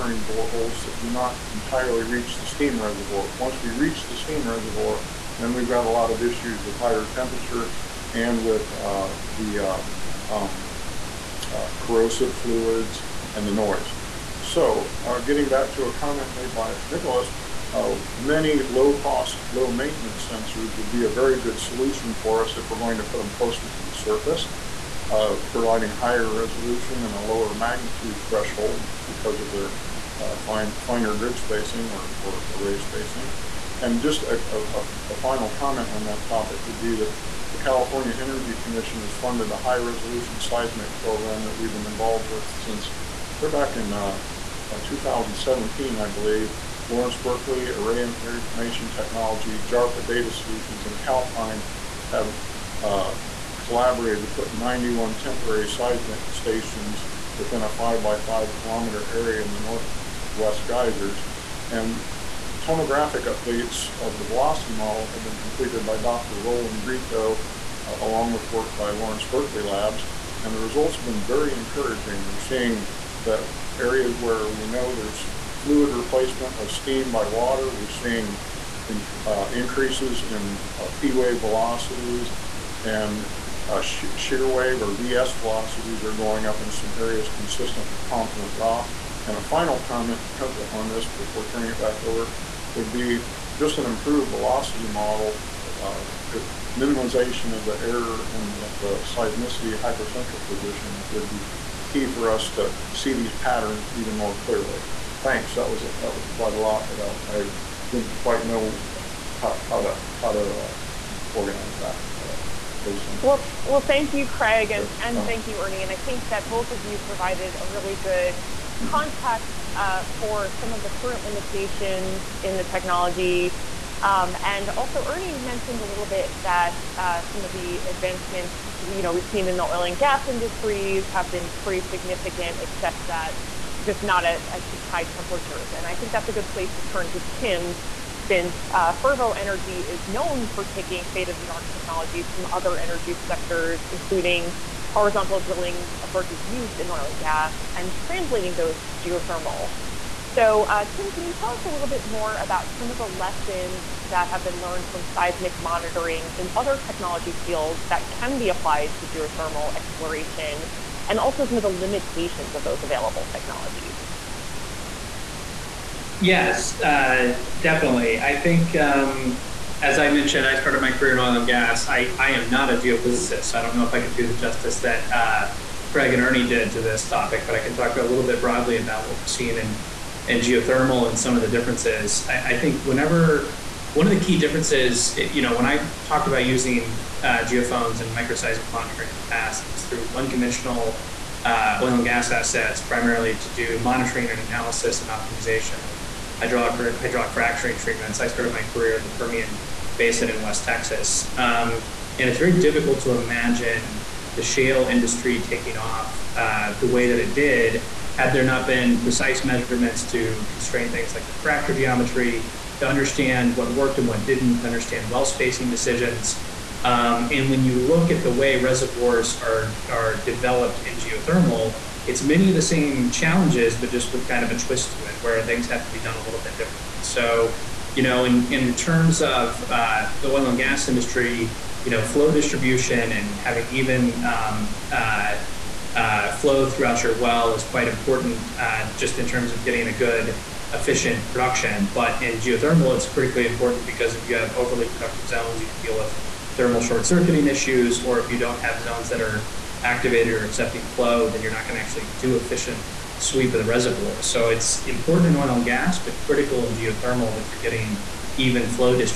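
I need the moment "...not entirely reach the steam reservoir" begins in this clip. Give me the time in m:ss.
0:01.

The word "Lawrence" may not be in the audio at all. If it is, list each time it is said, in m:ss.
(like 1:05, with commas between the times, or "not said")
0:46, 1:08.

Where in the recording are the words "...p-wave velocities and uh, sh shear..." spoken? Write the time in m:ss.
1:20.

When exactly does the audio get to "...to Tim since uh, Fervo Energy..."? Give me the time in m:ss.
2:17.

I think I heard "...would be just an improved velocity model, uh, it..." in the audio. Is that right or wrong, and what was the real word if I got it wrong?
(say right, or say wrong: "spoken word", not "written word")
right.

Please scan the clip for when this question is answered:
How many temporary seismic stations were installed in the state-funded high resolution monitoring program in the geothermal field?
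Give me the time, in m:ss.
0:54.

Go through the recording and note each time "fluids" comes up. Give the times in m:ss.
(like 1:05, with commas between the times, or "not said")
0:12, 1:15.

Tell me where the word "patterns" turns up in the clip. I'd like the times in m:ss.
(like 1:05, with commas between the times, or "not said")
1:43.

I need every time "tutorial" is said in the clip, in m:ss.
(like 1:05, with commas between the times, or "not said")
not said.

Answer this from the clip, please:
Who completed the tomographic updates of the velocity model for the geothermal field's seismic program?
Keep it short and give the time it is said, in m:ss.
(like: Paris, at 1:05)
Dr. Roland Gritto, at 1:05.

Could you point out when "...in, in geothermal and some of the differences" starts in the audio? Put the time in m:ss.
2:59.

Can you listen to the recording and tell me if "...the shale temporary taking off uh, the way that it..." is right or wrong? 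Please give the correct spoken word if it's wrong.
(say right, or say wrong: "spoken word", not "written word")
wrong: "industry", not "temporary".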